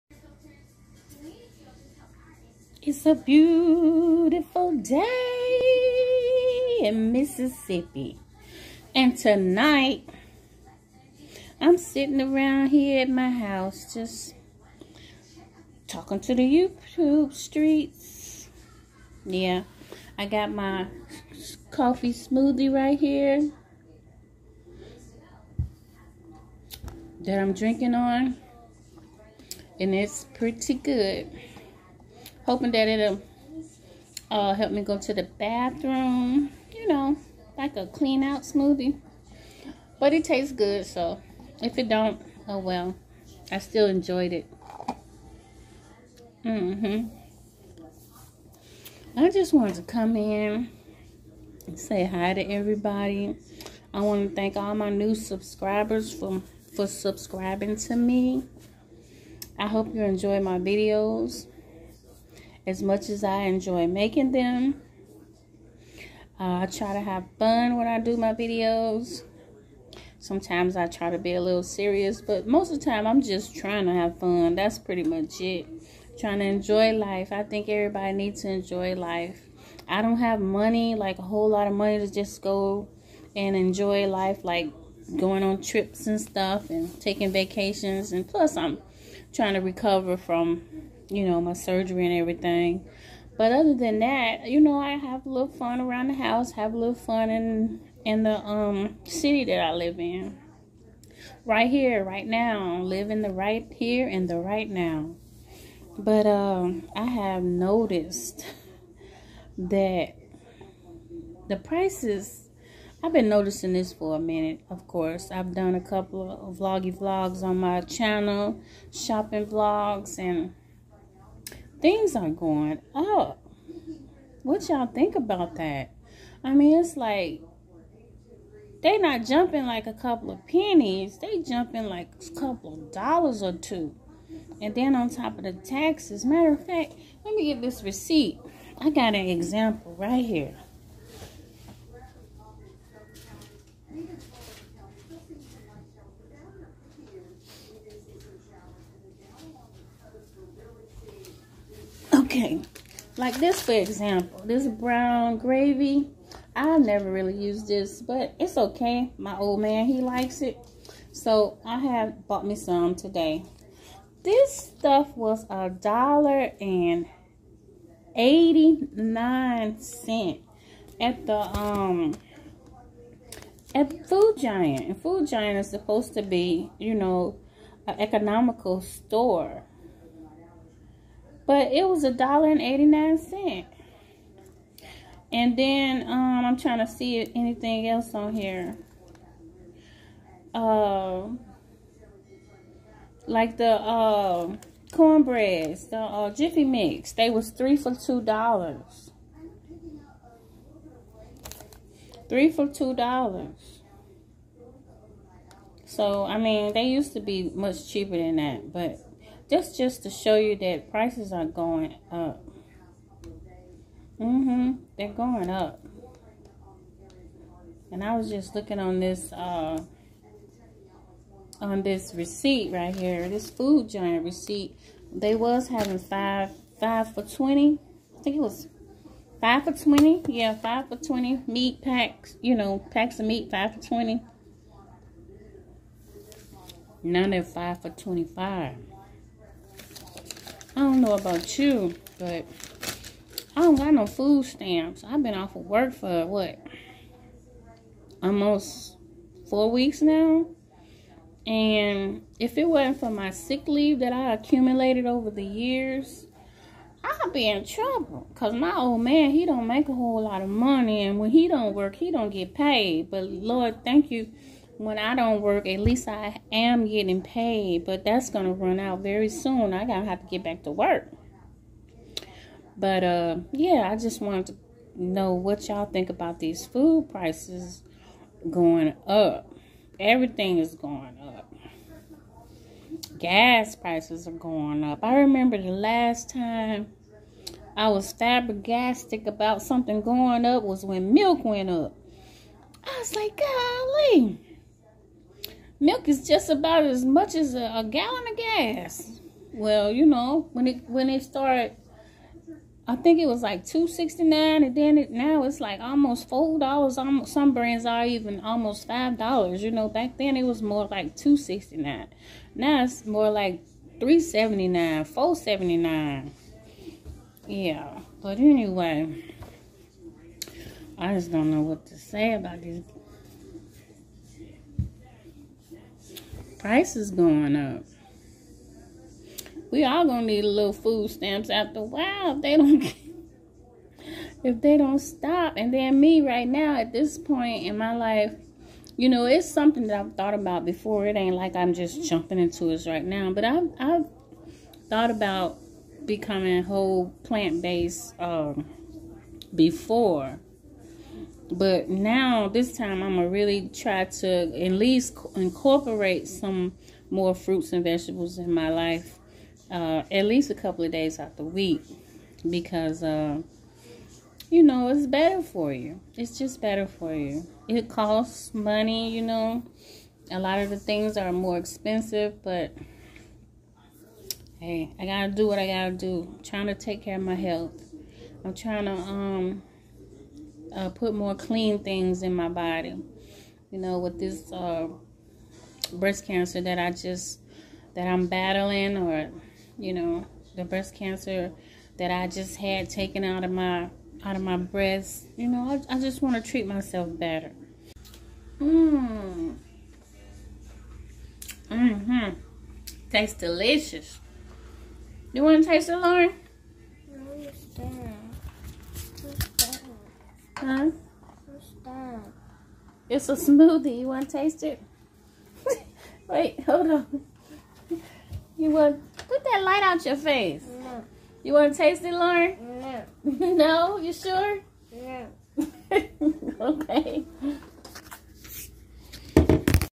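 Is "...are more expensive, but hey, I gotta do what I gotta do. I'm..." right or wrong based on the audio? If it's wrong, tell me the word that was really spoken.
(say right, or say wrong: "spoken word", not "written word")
right.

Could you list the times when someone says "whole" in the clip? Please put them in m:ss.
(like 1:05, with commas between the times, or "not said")
1:21, 4:19, 5:46.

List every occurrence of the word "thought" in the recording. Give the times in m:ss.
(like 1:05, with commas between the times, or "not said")
5:40, 5:44.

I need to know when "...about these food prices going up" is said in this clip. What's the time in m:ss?
4:36.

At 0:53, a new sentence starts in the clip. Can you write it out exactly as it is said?
I want to thank all my new subscribers for, for subscribing to me.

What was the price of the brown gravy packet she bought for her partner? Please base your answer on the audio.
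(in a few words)
$1.89.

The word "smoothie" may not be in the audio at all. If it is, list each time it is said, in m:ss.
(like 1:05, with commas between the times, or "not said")
0:22, 0:38, 6:53.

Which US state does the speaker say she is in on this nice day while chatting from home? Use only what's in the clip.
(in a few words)
Mississippi.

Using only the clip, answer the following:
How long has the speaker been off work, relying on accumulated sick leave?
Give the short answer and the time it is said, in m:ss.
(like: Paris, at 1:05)
Almost 4 weeks, at 4:08.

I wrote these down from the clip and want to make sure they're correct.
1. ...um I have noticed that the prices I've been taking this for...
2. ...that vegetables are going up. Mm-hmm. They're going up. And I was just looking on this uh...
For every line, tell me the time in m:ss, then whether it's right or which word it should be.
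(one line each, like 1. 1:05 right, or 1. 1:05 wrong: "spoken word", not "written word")
1. 1:46 wrong: "noticing", not "taking"
2. 3:30 wrong: "prices", not "vegetables".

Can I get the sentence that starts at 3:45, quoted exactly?
They was having five five for twenty.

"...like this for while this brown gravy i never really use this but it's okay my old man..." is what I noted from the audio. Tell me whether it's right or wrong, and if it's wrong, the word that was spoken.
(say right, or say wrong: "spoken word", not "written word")
wrong: "example", not "while".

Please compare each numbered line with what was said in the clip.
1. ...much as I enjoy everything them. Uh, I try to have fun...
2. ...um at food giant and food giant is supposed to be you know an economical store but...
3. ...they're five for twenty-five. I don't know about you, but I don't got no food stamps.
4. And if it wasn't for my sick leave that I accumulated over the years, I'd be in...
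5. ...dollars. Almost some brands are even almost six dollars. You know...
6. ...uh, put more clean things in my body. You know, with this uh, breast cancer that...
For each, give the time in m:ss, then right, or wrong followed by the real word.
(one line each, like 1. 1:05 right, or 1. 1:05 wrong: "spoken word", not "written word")
1. 1:02 wrong: "making", not "everything"
2. 2:51 right
3. 3:57 right
4. 4:11 right
5. 5:06 wrong: "five", not "six"
6. 6:20 right.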